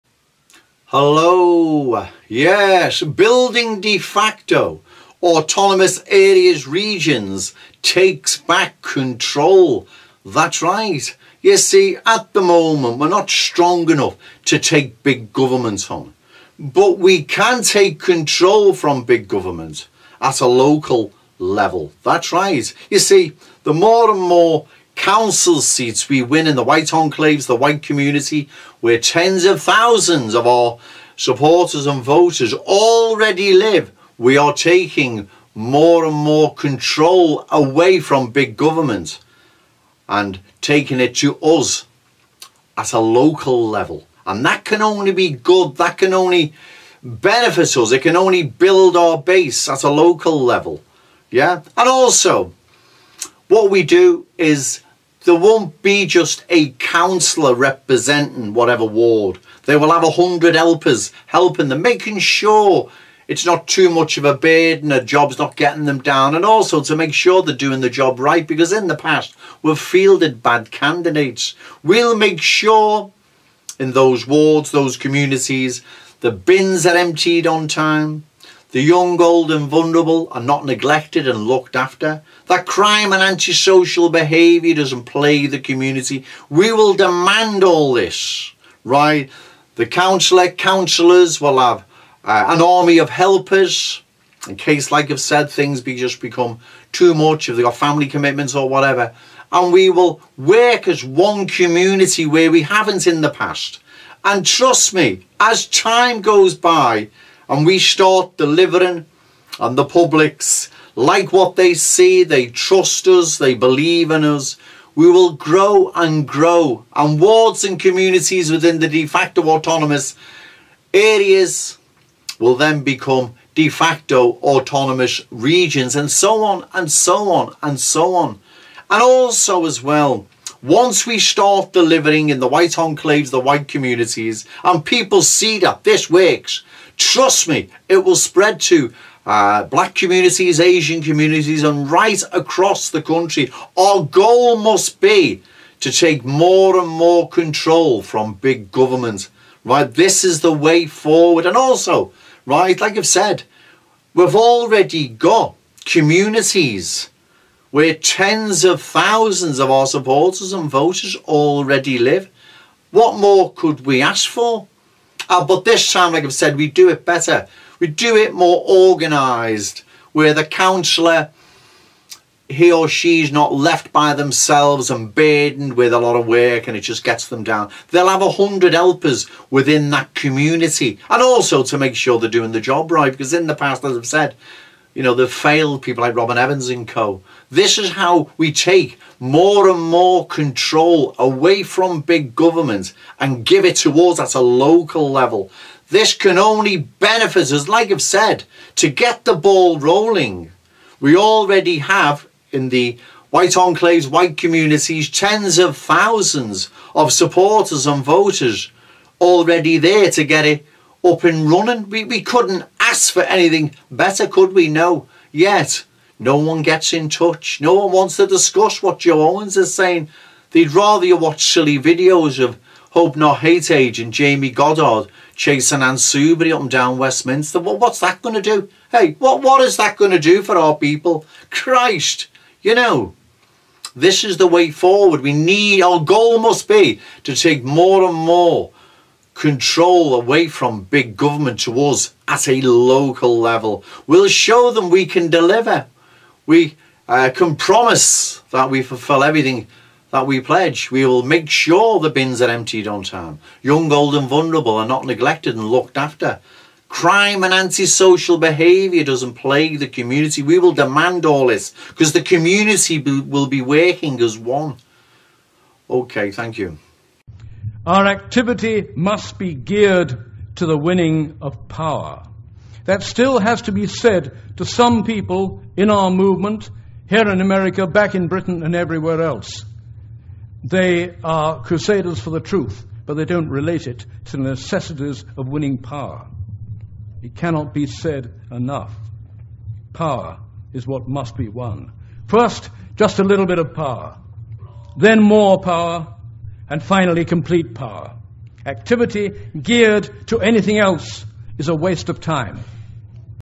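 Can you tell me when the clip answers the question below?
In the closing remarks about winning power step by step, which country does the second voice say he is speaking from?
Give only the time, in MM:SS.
04:37.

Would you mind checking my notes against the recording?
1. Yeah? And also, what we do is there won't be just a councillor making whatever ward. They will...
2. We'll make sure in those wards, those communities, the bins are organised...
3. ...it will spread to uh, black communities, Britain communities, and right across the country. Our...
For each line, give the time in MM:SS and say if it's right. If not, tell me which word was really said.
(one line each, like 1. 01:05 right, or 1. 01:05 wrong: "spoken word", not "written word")
1. 00:51 wrong: "representing", not "making"
2. 01:11 wrong: "emptied", not "organised"
3. 02:17 wrong: "Asian", not "Britain".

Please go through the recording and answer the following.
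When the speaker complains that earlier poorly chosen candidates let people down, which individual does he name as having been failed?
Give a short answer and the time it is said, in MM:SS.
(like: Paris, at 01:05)
Robin Evans, at 03:06.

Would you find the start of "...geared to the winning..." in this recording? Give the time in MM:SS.
04:29.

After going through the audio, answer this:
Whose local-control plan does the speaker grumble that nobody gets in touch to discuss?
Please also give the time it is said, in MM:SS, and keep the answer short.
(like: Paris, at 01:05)
Joe Owens, at 03:38.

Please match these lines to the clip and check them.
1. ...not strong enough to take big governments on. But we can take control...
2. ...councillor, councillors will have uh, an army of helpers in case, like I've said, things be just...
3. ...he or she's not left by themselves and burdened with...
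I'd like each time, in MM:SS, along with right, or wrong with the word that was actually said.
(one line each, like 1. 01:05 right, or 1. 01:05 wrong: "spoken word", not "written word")
1. 00:13 right
2. 01:29 right
3. 02:52 right.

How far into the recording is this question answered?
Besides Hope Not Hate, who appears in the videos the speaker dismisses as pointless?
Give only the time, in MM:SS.
03:44.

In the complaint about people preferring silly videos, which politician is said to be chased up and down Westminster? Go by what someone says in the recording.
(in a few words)
Anne Soubry.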